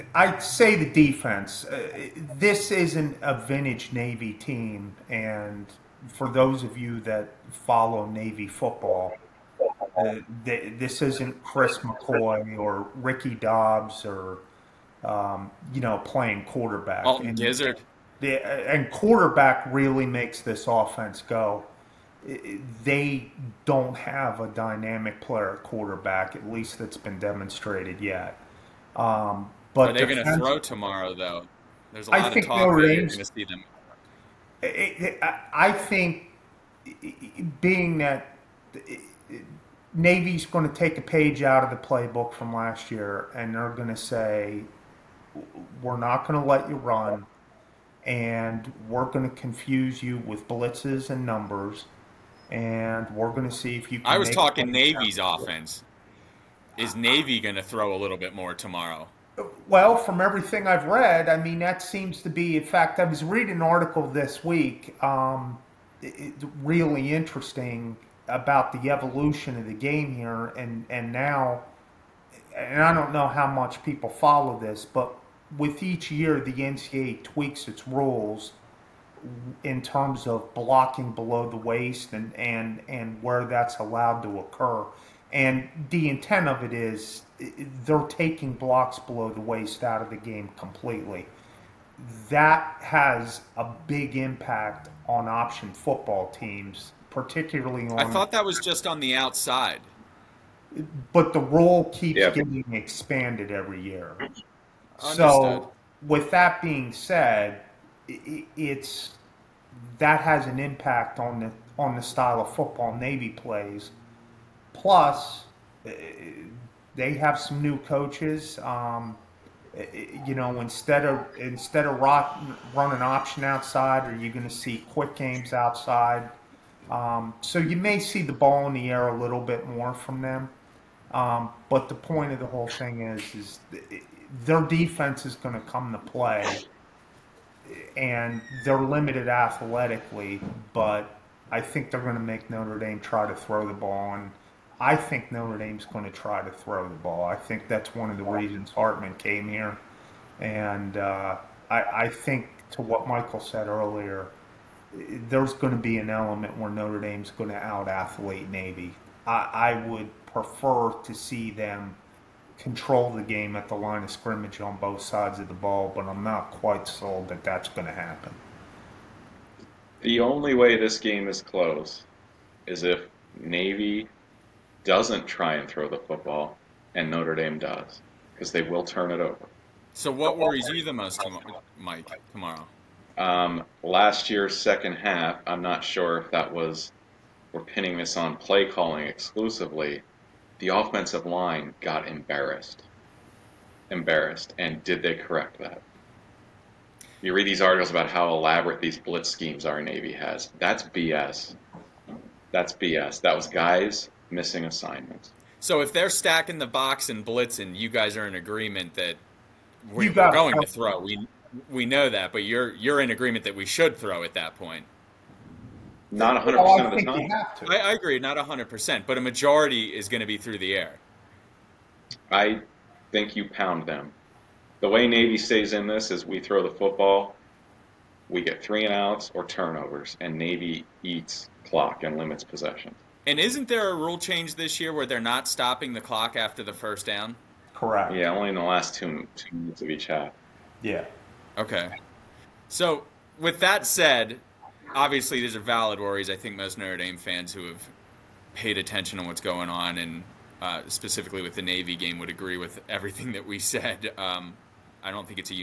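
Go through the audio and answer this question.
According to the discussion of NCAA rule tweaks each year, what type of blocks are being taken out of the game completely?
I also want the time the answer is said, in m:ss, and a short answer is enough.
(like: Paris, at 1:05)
Blocks below the waist, at 1:28.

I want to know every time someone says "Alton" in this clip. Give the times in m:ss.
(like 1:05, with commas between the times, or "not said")
0:17.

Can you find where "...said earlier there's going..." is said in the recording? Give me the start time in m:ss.
2:33.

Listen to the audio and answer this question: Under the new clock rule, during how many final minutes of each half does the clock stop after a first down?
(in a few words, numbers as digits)
2.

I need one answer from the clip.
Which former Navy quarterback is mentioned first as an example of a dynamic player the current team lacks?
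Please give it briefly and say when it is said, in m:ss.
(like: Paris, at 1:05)
Chris McCoy, at 0:11.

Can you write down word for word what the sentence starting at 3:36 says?
Not 100% well, of the time.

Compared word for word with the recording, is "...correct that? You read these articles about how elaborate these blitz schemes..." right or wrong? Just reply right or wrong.
right.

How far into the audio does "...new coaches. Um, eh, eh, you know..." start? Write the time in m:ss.
1:57.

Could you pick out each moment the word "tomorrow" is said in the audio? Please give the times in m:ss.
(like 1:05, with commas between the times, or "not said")
0:30, 0:58, 3:02.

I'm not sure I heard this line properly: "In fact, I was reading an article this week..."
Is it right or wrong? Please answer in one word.
right.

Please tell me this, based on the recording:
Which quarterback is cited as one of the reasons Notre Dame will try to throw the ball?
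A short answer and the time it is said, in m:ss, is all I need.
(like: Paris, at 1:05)
Hartman, at 2:28.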